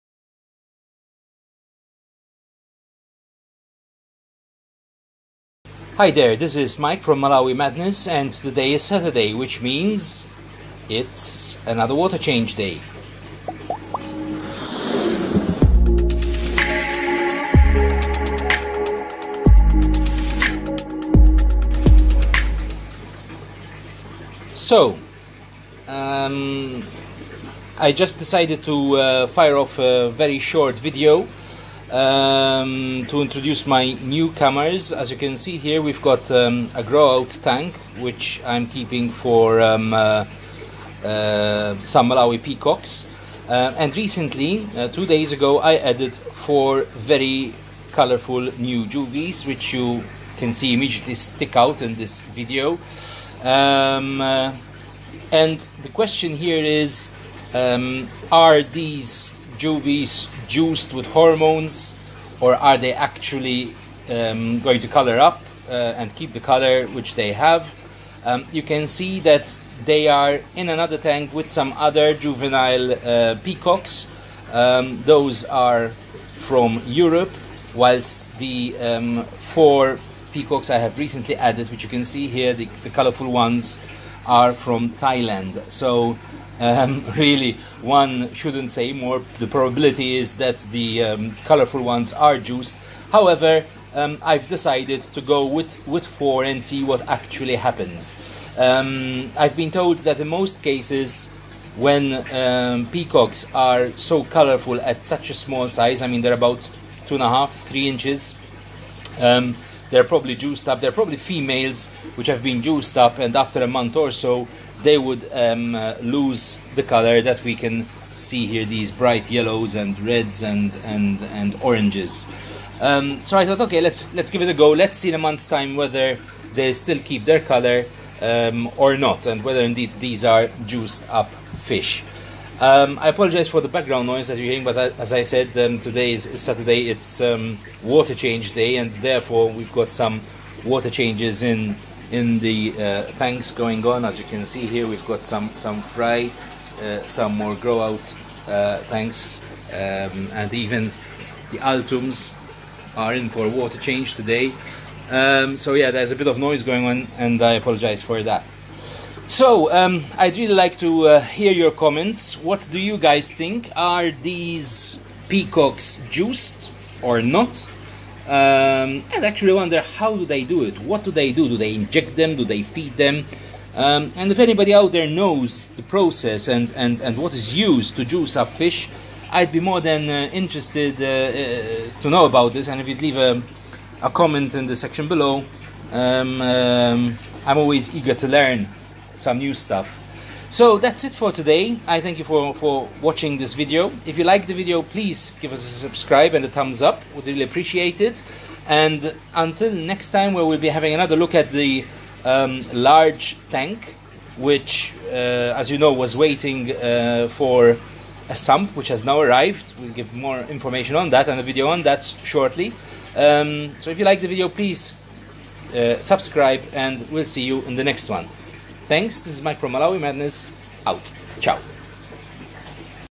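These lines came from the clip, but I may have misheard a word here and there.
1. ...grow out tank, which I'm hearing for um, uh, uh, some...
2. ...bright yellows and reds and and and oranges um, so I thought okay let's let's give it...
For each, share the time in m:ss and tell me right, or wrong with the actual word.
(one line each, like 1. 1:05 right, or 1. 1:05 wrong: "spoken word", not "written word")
1. 0:36 wrong: "keeping", not "hearing"
2. 1:58 right.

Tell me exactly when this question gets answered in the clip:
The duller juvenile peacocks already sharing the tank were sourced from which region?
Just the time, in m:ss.
1:16.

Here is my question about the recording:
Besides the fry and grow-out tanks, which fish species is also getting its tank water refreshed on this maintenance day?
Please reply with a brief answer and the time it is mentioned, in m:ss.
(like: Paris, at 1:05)
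Altums, at 2:31.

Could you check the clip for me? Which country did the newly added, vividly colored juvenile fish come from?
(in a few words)
Thailand.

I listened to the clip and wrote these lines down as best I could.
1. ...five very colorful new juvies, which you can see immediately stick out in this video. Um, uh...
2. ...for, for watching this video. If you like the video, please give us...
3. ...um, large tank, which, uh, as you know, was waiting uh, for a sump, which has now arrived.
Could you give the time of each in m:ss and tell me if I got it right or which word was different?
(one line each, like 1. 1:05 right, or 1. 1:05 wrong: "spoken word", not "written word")
1. 0:46 wrong: "four", not "five"
2. 3:12 right
3. 3:22 right.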